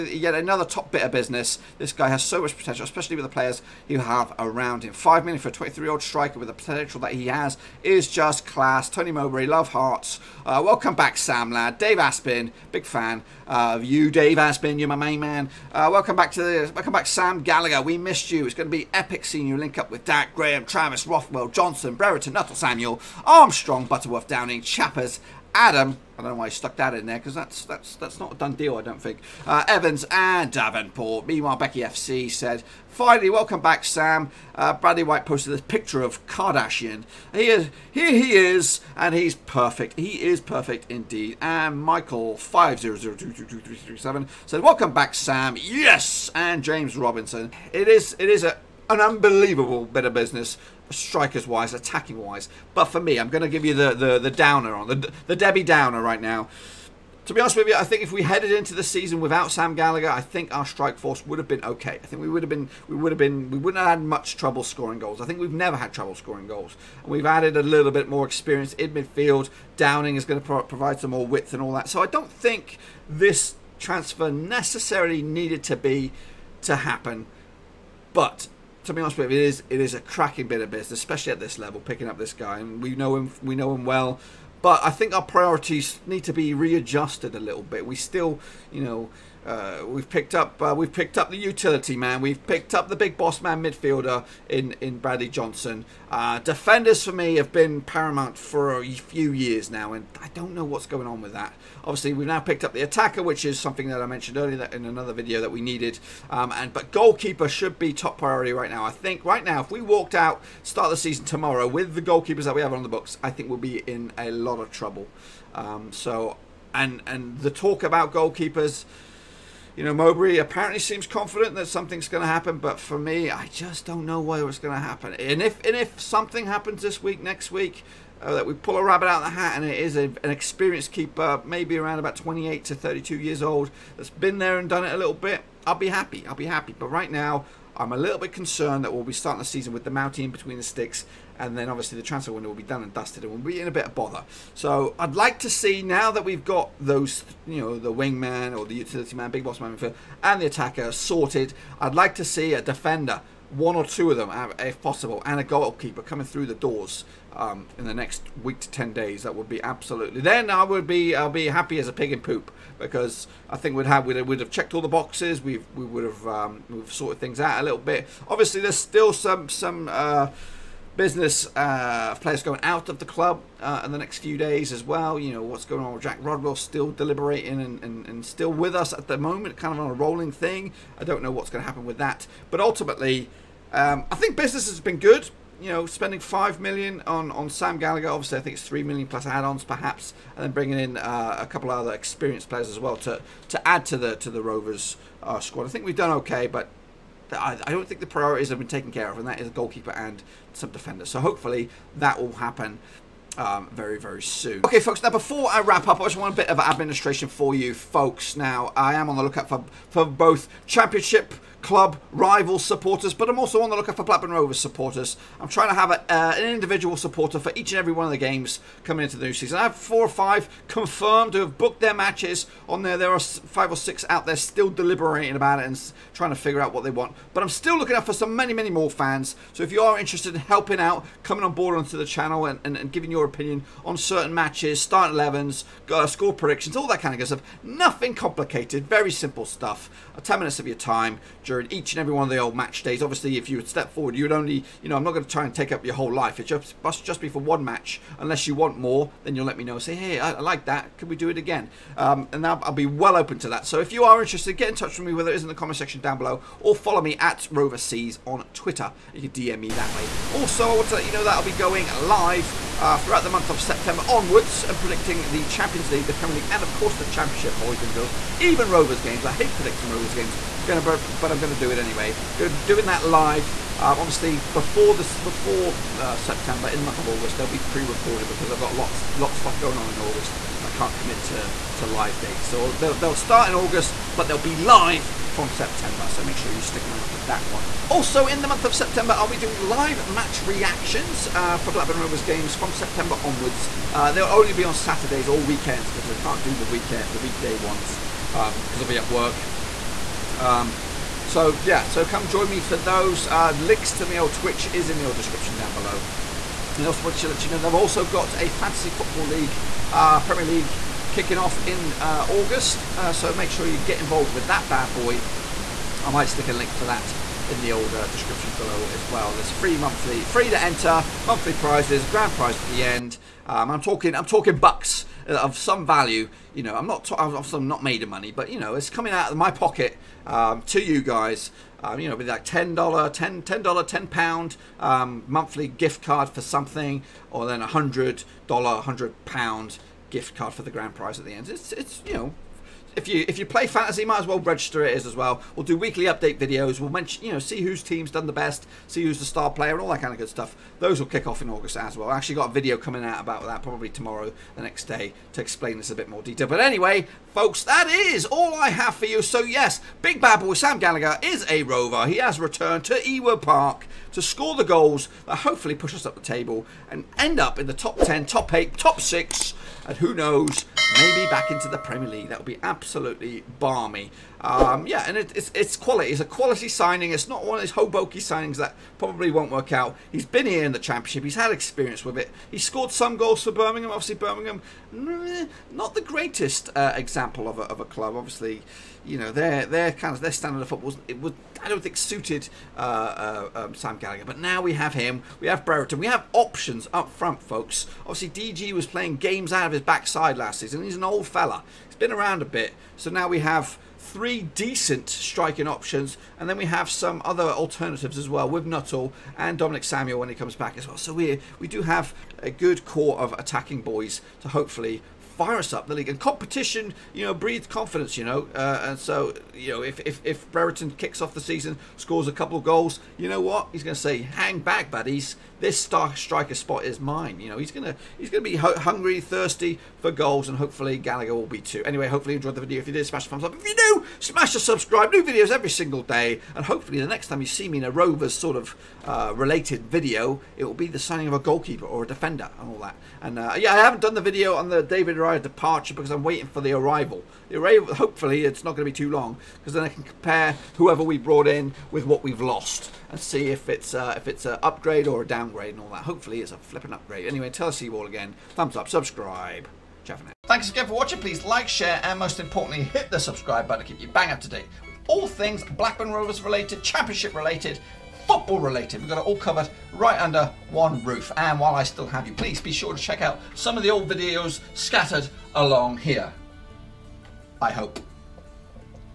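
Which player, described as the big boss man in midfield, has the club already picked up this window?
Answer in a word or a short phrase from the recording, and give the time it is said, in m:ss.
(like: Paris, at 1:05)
Bradley Johnson, at 1:34.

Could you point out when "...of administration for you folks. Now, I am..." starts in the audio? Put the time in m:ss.
3:26.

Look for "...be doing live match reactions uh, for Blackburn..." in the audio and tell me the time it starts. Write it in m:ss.
4:49.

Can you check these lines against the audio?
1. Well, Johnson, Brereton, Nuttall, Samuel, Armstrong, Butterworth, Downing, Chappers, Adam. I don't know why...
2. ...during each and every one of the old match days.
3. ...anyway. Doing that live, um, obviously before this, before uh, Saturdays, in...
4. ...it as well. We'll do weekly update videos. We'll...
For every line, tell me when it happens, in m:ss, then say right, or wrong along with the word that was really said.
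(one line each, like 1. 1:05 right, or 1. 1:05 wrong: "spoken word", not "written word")
1. 0:21 right
2. 4:01 right
3. 4:31 wrong: "September", not "Saturdays"
4. 5:44 right.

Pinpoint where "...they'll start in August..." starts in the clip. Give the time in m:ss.
4:42.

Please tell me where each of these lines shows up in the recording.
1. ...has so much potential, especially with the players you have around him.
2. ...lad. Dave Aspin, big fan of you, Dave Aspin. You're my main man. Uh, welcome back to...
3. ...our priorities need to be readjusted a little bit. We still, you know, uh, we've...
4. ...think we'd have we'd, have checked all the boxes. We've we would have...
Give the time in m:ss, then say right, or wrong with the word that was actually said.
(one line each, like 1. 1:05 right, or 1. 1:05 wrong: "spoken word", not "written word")
1. 0:02 right
2. 0:11 right
3. 1:25 right
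4. 2:43 right.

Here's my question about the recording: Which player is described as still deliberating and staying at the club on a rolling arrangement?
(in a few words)
Jack Rodwell.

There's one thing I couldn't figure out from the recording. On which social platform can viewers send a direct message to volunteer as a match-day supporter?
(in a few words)
Twitter.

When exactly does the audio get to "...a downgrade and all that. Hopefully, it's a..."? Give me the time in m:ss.
7:35.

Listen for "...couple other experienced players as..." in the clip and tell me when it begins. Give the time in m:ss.
3:11.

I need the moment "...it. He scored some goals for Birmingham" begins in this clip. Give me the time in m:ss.
6:22.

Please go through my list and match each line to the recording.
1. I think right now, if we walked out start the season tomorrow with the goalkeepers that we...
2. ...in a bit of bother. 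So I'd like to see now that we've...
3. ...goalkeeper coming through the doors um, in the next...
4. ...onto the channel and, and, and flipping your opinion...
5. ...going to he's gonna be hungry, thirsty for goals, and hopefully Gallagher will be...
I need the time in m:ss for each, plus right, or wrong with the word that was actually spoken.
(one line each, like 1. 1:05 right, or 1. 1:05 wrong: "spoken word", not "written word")
1. 1:48 right
2. 2:23 right
3. 2:35 right
4. 3:51 wrong: "giving", not "flipping"
5. 7:07 right.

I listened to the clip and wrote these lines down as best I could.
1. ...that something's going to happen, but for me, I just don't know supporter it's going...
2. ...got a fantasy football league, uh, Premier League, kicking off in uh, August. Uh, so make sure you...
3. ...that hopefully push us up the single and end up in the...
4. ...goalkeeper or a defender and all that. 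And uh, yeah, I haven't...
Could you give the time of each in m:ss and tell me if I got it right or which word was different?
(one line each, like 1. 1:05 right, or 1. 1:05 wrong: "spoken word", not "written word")
1. 2:01 wrong: "whether", not "supporter"
2. 5:08 right
3. 6:05 wrong: "table", not "single"
4. 7:21 right.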